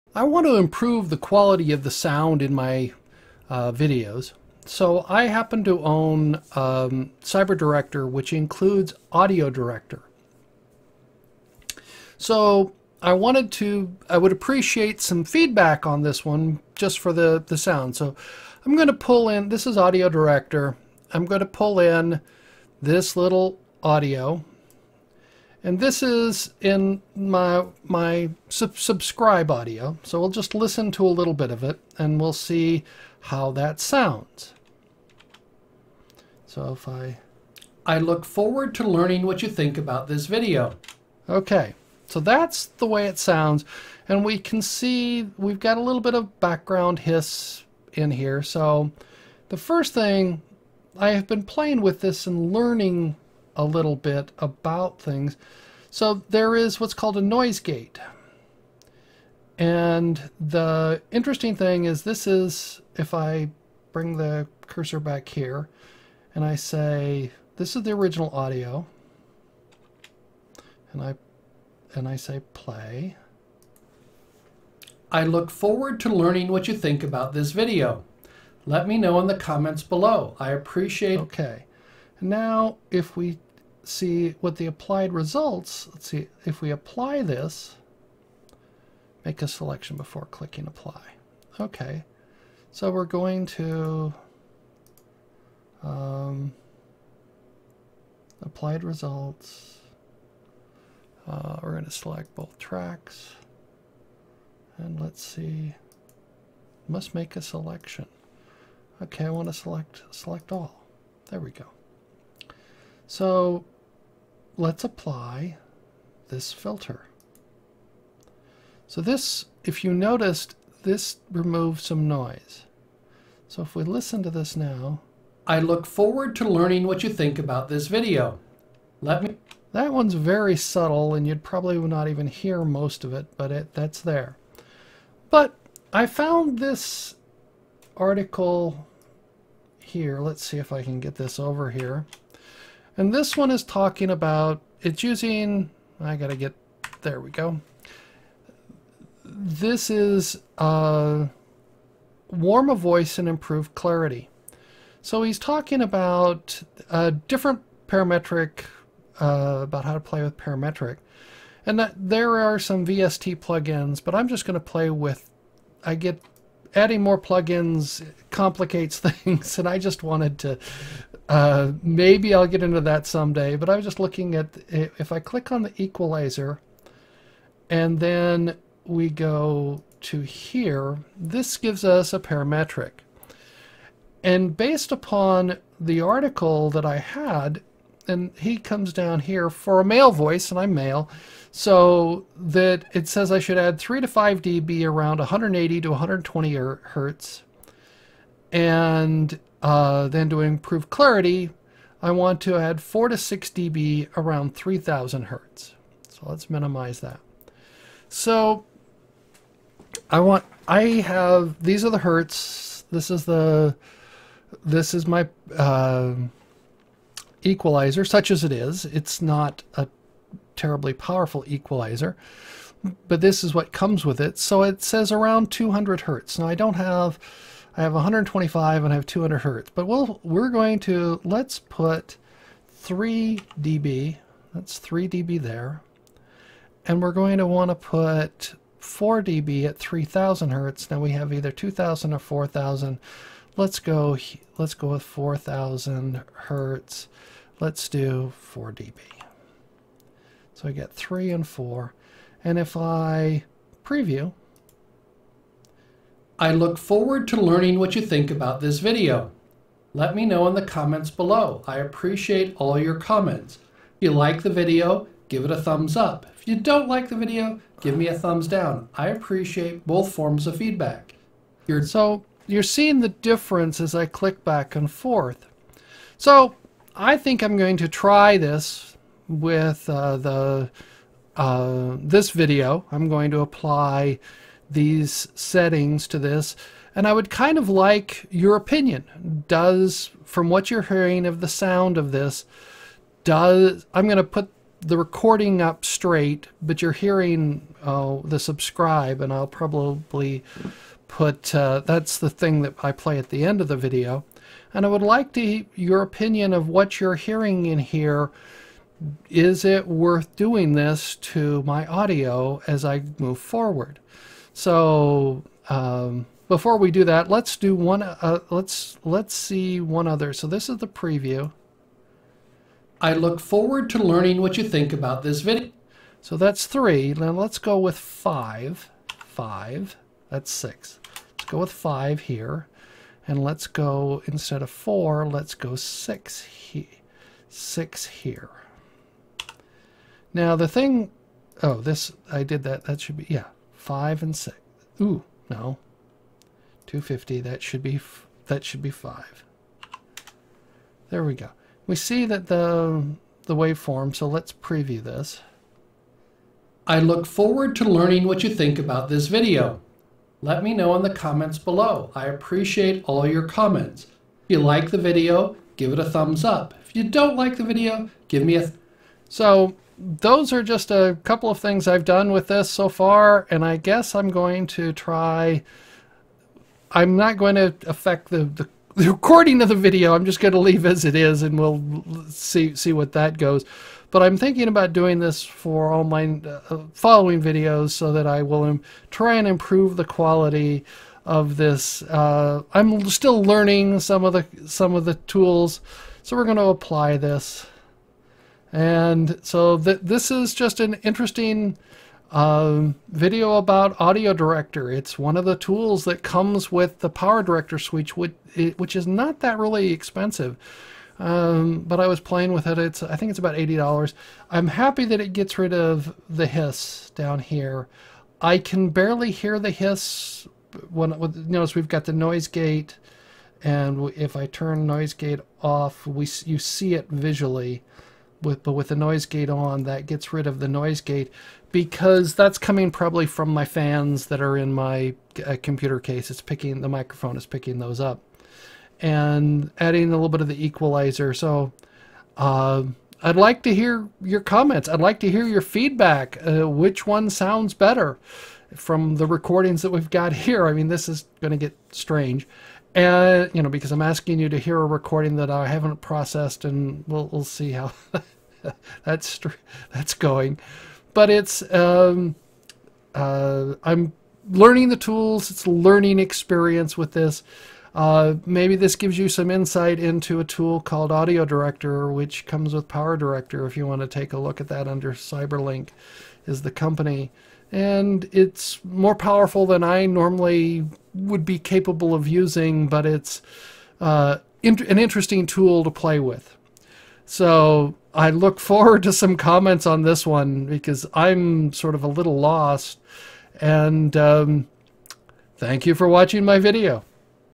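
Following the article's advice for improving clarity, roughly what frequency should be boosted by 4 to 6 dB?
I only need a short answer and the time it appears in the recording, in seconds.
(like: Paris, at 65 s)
3000 hertz, at 204 s.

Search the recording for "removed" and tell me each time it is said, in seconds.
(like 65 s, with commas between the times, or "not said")
121 s.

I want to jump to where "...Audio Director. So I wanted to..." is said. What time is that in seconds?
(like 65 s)
9 s.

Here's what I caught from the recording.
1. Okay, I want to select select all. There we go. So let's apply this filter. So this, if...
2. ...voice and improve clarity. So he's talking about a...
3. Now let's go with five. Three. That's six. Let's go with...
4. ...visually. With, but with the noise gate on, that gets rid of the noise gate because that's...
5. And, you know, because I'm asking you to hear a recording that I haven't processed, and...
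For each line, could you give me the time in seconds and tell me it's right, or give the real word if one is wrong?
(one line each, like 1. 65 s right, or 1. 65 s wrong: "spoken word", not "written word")
1. 109 s right
2. 152 s right
3. 327 s wrong: "Five", not "Three"
4. 427 s right
5. 452 s right.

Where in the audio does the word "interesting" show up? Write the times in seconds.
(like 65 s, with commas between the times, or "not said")
61 s, 401 s, 484 s.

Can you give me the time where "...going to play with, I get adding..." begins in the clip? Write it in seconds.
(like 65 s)
164 s.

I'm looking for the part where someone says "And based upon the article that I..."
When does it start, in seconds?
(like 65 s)
184 s.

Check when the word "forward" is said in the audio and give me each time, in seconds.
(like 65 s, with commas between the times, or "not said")
38 s, 75 s, 125 s, 256 s, 313 s, 323 s, 357 s, 488 s.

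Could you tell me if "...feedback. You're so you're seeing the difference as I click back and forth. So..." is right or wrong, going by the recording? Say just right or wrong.
right.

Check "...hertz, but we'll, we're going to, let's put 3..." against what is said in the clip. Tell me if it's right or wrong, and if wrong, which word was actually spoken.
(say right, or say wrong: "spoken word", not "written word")
right.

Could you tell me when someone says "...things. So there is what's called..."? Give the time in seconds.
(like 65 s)
55 s.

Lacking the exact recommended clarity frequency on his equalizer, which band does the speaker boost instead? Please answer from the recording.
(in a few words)
4000 hertz.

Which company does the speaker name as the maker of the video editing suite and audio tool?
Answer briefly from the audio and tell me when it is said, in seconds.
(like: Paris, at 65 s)
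Cyberlink, at 475 s.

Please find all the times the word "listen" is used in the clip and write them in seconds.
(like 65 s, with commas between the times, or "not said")
30 s, 123 s.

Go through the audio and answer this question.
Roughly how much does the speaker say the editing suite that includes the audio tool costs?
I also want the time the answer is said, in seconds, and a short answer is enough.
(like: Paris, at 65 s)
80 dollars, at 413 s.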